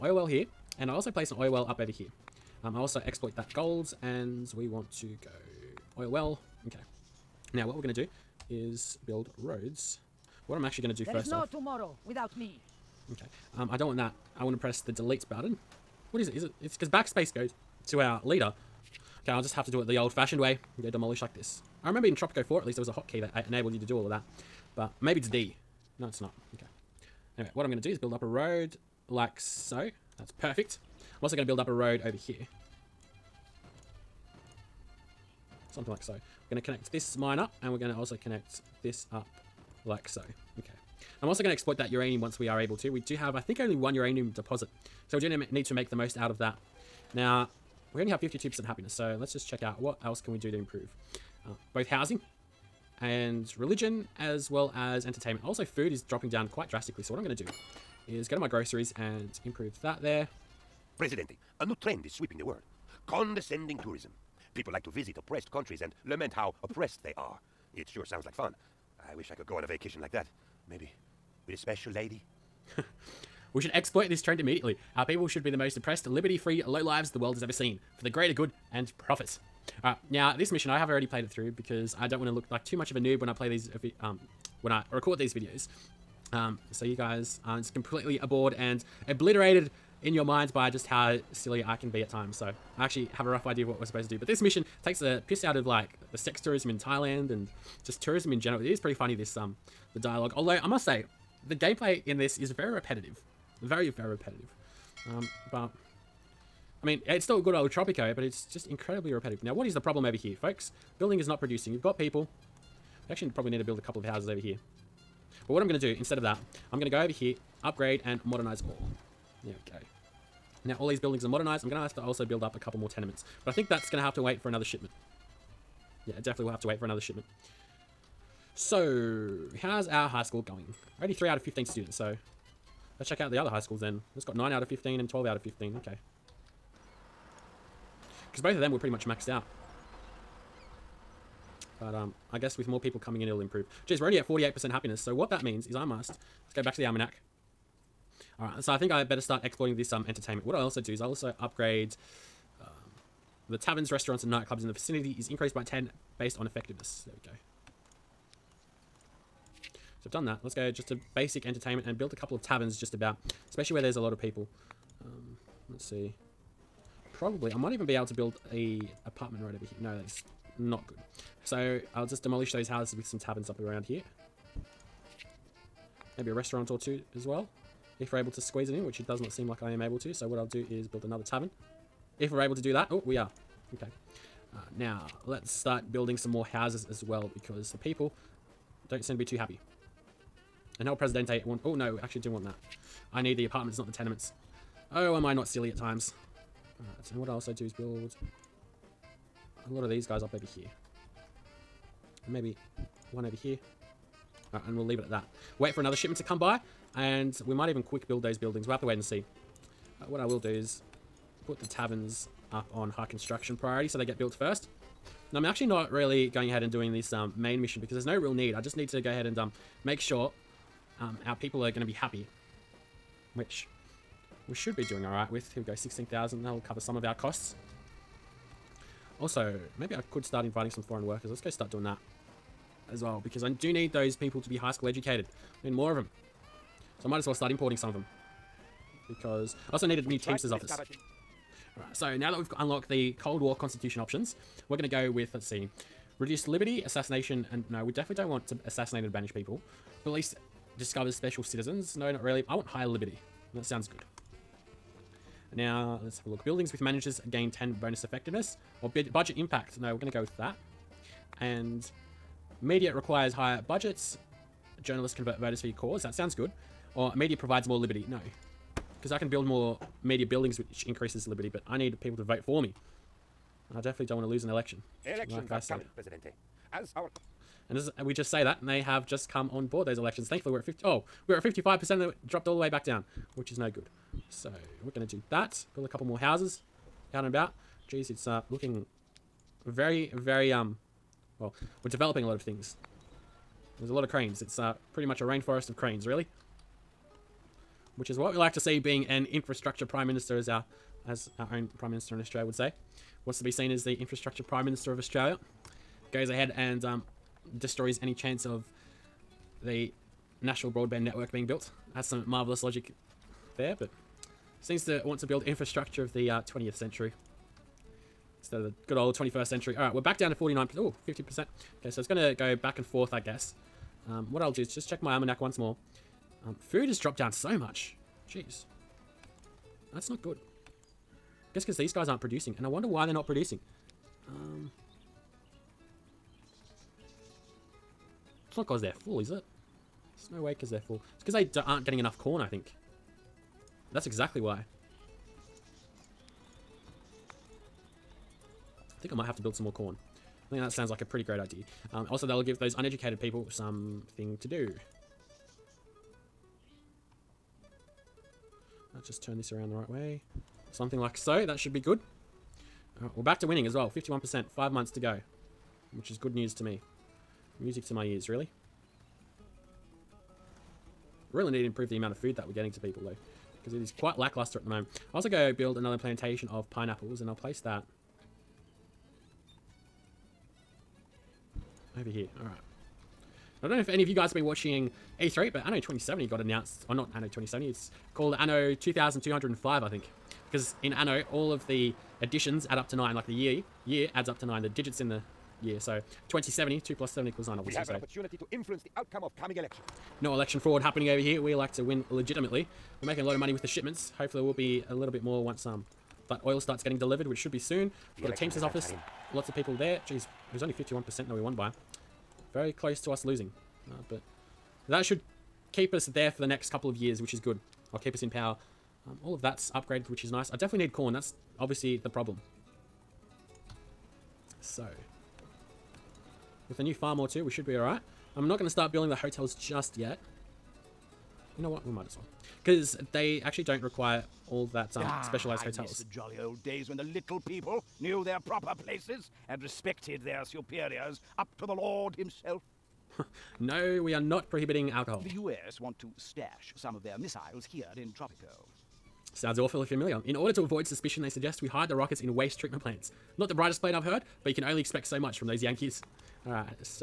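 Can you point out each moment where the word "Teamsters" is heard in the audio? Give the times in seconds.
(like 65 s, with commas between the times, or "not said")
240 s, 408 s.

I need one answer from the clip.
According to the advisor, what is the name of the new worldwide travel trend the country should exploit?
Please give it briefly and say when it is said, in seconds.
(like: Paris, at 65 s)
Condescending tourism, at 63 s.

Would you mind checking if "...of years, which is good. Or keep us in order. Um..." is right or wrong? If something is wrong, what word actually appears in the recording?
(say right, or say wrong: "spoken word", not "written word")
wrong: "power", not "order".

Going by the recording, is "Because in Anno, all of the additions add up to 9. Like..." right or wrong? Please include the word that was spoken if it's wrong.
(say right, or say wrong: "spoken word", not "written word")
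right.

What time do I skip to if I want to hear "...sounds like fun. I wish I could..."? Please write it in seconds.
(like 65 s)
68 s.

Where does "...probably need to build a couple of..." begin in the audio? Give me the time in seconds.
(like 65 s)
113 s.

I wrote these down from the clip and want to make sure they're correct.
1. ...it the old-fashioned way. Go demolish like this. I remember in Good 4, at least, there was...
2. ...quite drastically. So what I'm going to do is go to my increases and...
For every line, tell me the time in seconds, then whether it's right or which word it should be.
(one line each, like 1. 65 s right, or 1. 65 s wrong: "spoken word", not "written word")
1. 19 s wrong: "Tropico", not "Good"
2. 56 s wrong: "groceries", not "increases".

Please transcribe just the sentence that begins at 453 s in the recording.
Not the brightest plan I've heard, but you can only expect so much from those Yankees.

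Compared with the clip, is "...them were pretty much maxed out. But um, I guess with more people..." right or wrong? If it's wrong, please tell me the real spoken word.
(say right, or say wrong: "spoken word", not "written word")
right.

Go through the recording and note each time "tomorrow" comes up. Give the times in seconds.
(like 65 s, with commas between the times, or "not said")
11 s.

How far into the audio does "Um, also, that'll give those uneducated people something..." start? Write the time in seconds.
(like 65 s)
351 s.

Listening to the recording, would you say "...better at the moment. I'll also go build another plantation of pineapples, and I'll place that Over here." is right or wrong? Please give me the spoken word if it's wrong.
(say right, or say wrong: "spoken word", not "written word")
wrong: "lackluster", not "better".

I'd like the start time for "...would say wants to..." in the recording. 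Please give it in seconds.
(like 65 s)
302 s.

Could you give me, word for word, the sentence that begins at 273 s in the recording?
I definitely don't want to lose an election.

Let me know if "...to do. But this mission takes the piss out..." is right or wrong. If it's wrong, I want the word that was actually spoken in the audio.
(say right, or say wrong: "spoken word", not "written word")
right.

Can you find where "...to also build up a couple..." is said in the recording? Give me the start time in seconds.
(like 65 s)
121 s.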